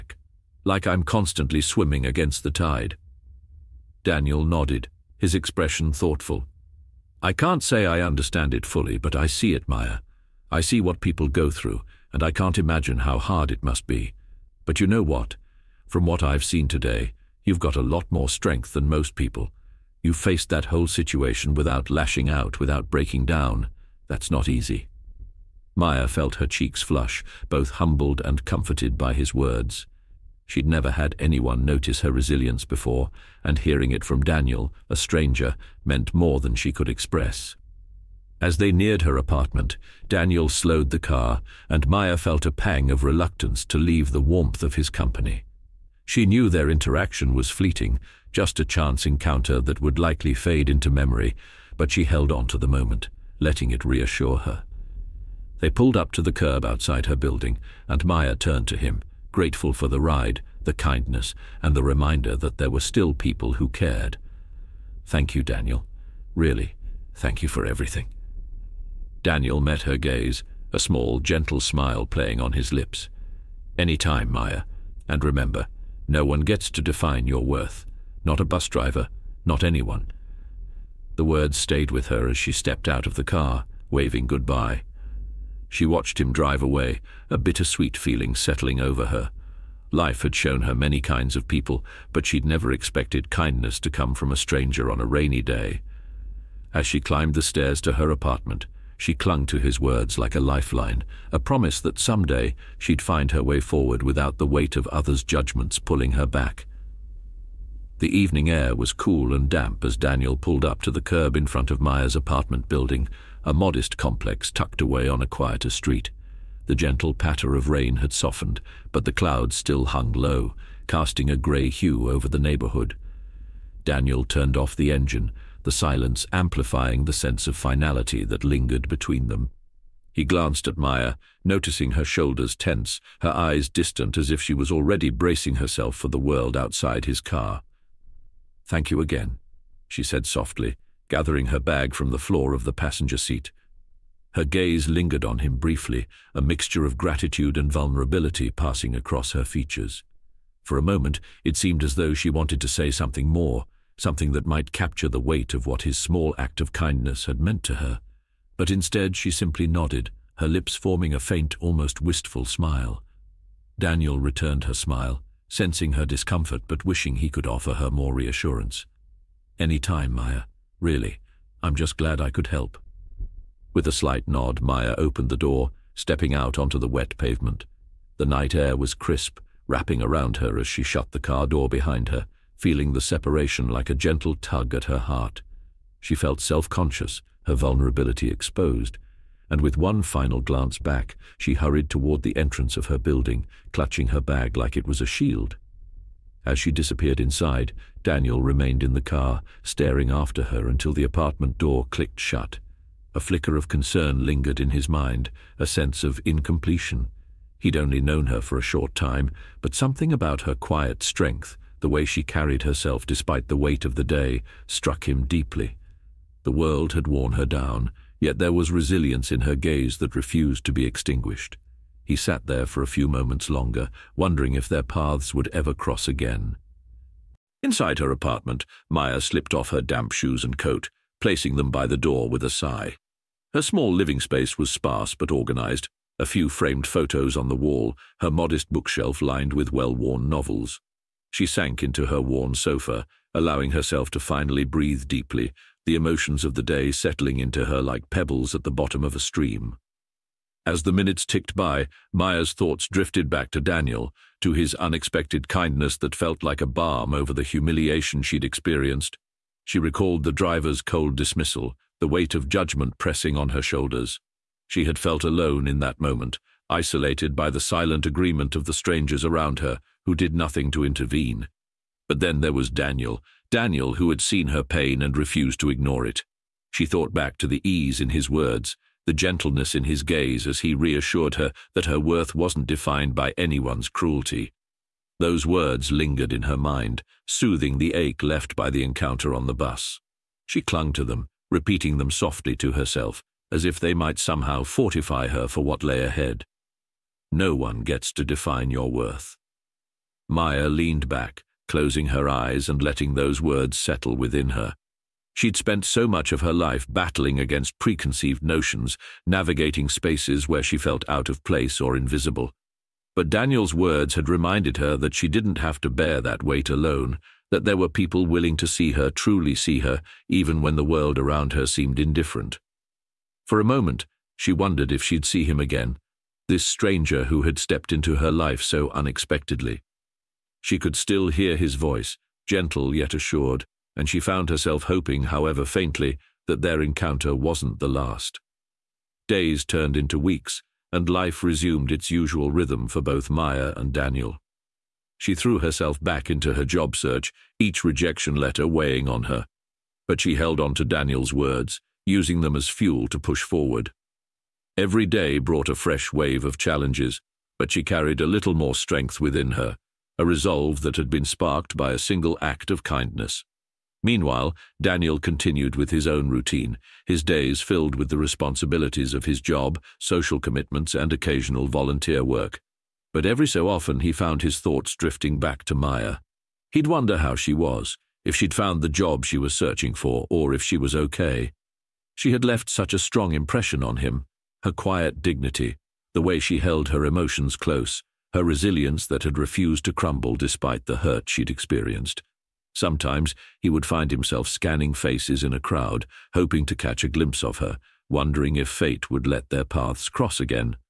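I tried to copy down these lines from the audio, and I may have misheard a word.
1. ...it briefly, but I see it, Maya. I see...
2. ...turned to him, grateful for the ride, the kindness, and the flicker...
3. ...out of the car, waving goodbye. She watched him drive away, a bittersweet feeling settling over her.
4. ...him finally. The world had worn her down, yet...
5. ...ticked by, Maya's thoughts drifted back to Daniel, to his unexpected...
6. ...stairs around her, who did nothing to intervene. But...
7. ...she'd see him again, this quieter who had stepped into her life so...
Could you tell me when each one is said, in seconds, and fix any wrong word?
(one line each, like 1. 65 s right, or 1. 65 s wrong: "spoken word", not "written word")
1. 8 s wrong: "fully", not "briefly"
2. 58 s wrong: "reminder", not "flicker"
3. 82 s right
4. 215 s wrong: "deeply", not "finally"
5. 251 s right
6. 268 s wrong: "strangers", not "stairs"
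7. 325 s wrong: "stranger", not "quieter".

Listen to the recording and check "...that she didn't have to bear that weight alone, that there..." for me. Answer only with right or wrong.
right.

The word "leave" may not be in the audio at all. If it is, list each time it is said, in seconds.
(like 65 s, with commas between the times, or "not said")
43 s.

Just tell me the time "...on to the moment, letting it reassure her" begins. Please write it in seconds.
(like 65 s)
52 s.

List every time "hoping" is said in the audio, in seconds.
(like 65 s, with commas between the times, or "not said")
334 s, 396 s.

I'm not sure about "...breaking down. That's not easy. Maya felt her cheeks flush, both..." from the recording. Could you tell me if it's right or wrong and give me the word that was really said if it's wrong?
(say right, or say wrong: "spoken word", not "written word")
right.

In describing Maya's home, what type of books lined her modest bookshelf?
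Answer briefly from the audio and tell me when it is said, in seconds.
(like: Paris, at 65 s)
well-worn novels, at 239 s.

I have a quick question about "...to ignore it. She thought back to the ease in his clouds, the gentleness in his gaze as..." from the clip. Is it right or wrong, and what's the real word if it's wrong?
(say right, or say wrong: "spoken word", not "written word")
wrong: "words", not "clouds".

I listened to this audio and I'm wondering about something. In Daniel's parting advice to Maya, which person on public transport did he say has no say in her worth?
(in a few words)
bus driver.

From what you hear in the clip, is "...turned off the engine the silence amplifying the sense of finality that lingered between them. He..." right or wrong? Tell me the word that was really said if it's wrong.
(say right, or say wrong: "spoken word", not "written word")
right.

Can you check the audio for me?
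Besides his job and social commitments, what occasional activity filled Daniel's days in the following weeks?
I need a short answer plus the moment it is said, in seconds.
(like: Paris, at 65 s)
volunteer work, at 371 s.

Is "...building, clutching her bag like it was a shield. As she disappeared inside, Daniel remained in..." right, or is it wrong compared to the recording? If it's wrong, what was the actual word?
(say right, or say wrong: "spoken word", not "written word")
right.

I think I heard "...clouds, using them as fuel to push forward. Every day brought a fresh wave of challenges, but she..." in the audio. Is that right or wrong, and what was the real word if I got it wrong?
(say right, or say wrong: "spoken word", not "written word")
wrong: "words", not "clouds".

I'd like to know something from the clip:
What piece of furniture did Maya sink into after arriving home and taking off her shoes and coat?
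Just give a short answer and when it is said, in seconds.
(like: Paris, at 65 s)
sofa, at 242 s.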